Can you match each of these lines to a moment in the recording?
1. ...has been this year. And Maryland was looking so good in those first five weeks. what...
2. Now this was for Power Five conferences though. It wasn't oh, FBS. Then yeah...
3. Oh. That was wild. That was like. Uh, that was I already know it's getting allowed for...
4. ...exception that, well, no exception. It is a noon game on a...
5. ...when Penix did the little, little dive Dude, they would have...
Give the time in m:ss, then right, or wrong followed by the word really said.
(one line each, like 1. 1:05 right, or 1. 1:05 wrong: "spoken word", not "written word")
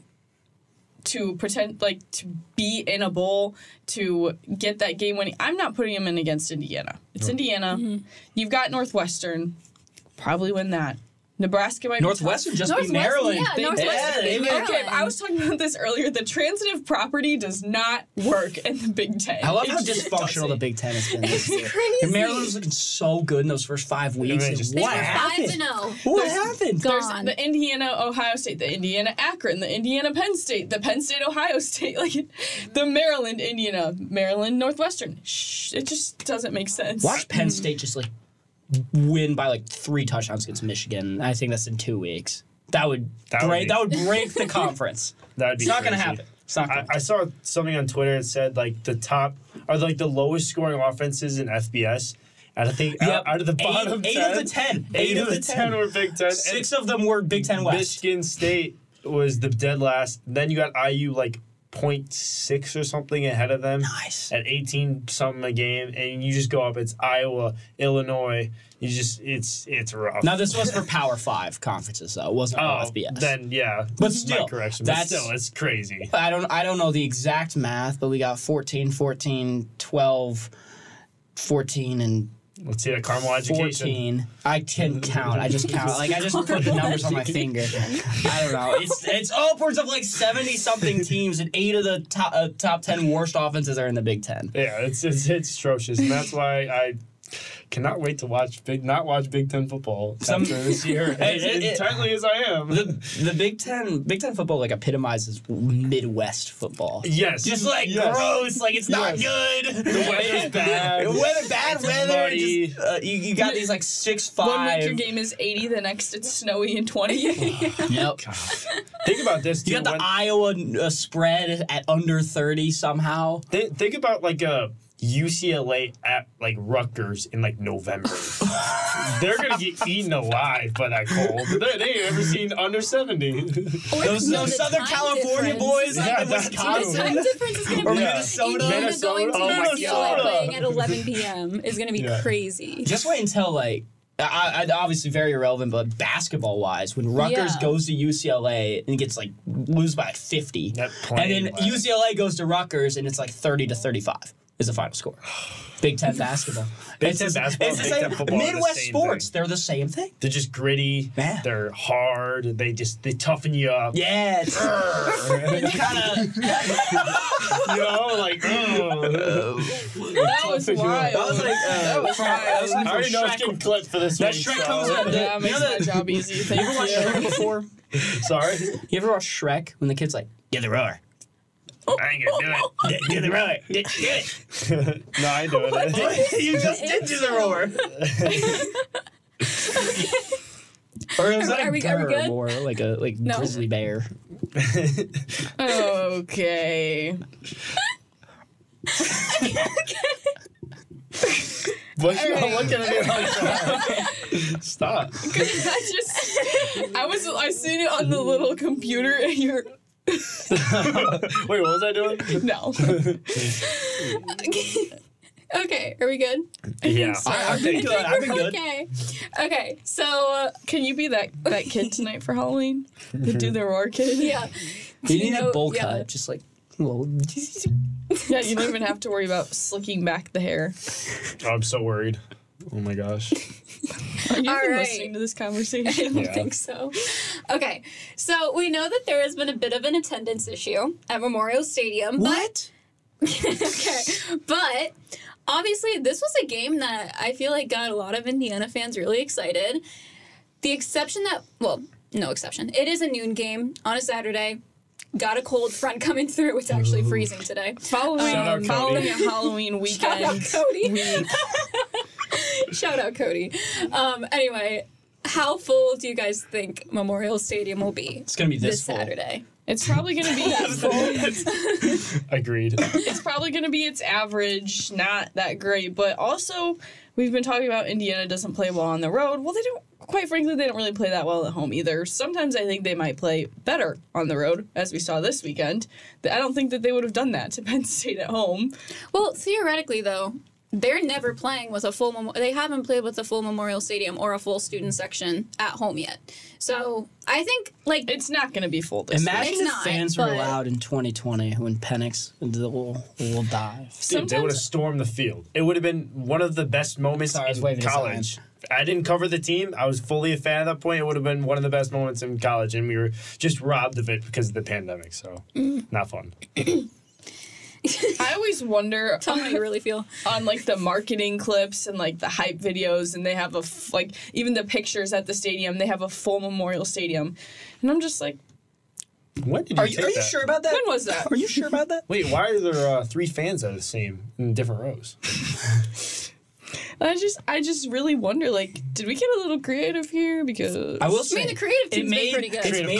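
1. 0:20 right
2. 1:10 right
3. 2:48 wrong: "clipped", not "allowed"
4. 4:10 right
5. 5:01 right.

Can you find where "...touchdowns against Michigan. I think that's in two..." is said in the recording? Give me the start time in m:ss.
0:40.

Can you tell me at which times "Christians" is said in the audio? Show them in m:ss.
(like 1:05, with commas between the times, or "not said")
not said.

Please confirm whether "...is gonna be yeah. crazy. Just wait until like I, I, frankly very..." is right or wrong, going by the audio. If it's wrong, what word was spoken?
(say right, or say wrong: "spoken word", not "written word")
wrong: "obviously", not "frankly".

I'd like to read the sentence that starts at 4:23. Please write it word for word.
Um, anyway, how full do you guys think Memorial Stadium will be?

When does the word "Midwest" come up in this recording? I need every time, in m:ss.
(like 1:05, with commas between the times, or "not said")
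1:45, 2:38.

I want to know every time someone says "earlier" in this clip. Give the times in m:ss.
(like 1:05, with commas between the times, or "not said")
0:15.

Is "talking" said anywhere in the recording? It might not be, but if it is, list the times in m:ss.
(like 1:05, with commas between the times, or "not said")
0:15, 4:37.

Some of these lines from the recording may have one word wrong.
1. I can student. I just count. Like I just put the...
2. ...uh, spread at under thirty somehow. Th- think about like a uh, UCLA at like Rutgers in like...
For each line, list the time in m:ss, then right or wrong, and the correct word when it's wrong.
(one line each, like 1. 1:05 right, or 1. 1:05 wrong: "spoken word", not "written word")
1. 1:24 wrong: "count", not "student"
2. 2:00 right.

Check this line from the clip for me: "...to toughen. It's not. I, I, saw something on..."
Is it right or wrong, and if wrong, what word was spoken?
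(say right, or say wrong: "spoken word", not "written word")
wrong: "happen", not "toughen".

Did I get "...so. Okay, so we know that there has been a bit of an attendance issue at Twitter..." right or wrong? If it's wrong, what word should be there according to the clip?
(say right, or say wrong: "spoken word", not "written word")
wrong: "Memorial", not "Twitter".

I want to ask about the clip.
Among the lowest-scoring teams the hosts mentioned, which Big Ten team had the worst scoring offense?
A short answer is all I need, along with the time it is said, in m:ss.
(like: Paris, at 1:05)
Michigan State, at 0:58.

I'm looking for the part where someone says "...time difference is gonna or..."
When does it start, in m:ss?
2:17.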